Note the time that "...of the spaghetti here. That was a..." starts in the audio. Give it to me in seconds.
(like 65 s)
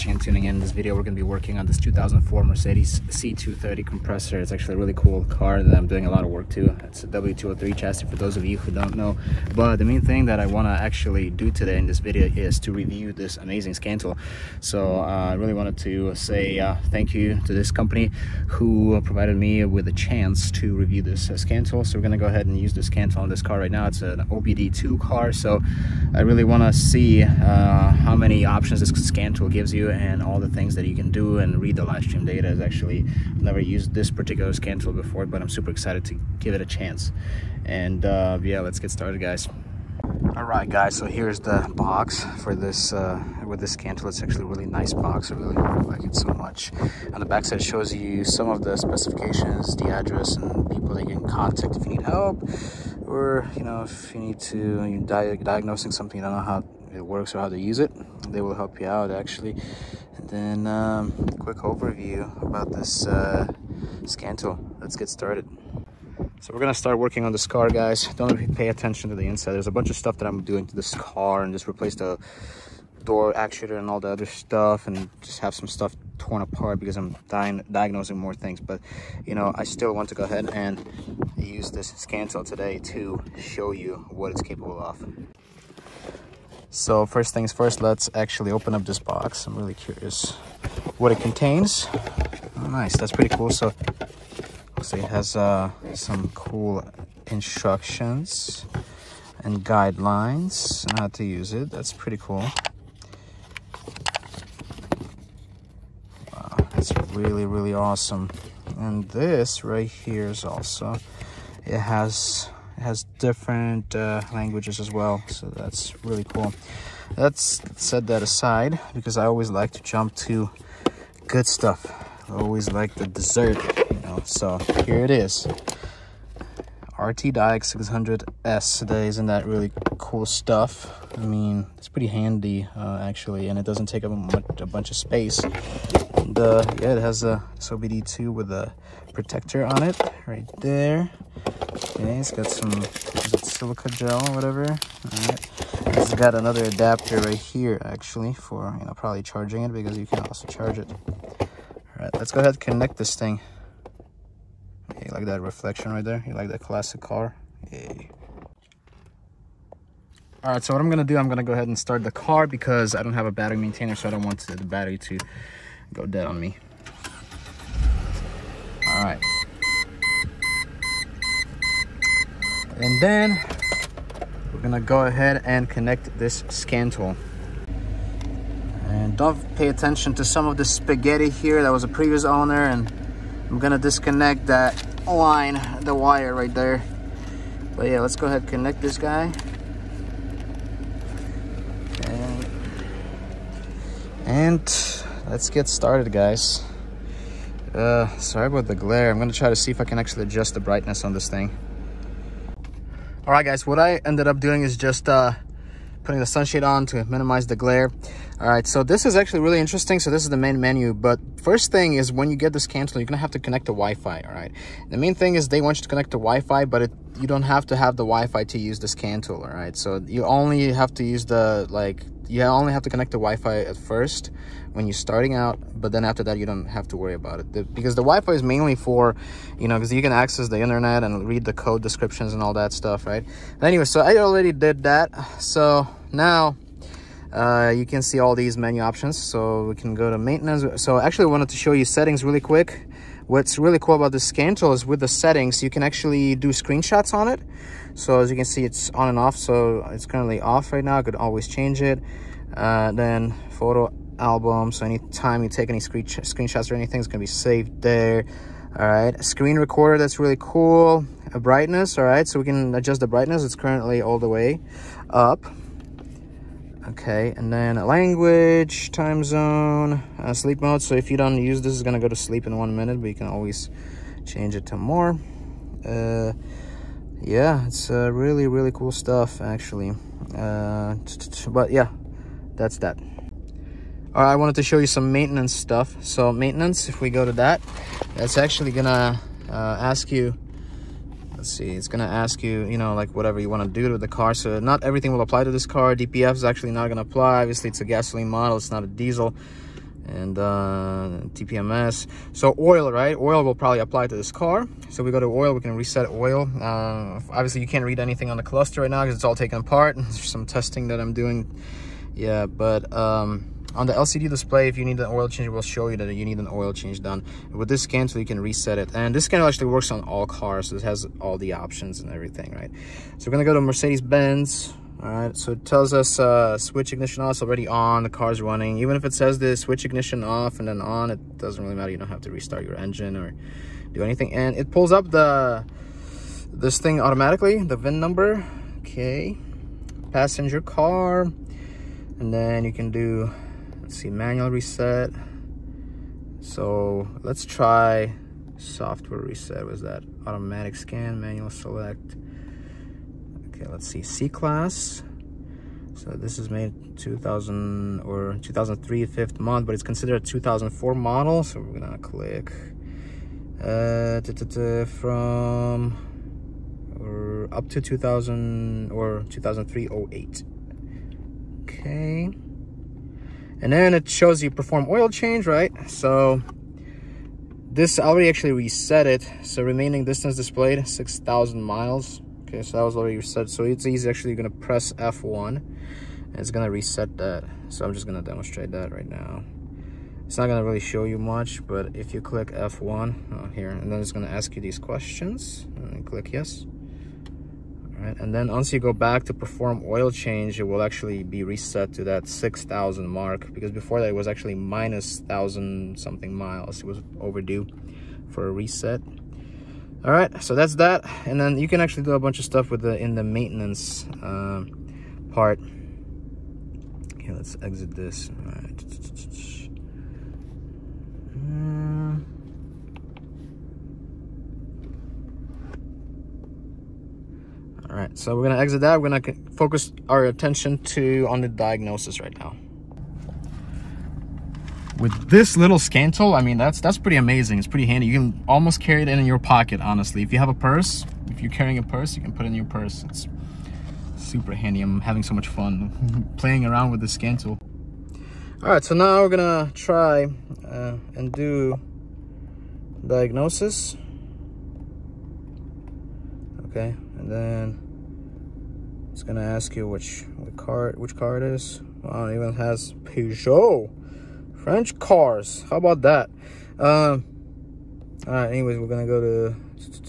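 180 s.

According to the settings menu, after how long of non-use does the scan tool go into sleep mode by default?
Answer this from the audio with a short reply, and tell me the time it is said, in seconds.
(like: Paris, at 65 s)
1 minute, at 272 s.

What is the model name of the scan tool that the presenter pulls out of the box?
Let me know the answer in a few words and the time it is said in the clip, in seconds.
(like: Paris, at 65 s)
ArtiDiag 600S, at 126 s.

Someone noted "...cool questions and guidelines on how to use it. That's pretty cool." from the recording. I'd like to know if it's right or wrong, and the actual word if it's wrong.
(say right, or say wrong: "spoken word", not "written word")
wrong: "instructions", not "questions".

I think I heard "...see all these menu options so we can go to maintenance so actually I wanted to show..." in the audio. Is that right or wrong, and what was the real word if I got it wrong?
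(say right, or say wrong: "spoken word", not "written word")
right.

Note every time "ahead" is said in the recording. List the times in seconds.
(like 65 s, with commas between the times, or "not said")
22 s, 80 s, 152 s, 161 s, 175 s, 188 s.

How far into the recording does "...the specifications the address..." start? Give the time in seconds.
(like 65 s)
48 s.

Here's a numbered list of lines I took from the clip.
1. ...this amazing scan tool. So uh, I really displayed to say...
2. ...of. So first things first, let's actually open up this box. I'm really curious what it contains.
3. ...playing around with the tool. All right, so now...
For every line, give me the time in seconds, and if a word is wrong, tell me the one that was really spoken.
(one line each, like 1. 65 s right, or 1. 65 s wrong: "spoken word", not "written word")
1. 13 s wrong: "wanted", not "displayed"
2. 84 s right
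3. 446 s right.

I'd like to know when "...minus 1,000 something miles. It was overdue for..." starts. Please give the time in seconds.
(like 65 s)
404 s.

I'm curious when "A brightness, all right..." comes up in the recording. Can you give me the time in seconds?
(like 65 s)
261 s.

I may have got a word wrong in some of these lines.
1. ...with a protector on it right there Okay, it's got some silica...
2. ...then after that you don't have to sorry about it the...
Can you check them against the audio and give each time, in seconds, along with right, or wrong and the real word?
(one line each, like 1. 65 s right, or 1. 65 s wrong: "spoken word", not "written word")
1. 138 s right
2. 225 s wrong: "worry", not "sorry".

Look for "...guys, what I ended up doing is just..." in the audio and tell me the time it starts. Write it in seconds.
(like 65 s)
203 s.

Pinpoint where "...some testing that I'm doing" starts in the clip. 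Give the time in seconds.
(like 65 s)
310 s.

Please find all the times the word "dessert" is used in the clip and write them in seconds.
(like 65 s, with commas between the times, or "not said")
123 s.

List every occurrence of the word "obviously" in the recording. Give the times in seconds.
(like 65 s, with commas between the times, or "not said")
297 s, 307 s.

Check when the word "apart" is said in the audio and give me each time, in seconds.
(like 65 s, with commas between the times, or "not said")
76 s, 309 s.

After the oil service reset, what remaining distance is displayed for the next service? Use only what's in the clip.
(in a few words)
6,000 miles.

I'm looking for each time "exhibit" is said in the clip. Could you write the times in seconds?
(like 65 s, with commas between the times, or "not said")
not said.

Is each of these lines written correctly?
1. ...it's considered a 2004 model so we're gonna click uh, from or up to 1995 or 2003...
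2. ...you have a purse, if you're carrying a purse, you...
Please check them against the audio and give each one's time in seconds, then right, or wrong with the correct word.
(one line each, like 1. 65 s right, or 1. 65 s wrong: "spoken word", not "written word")
1. 359 s wrong: "2000", not "1995"
2. 440 s right.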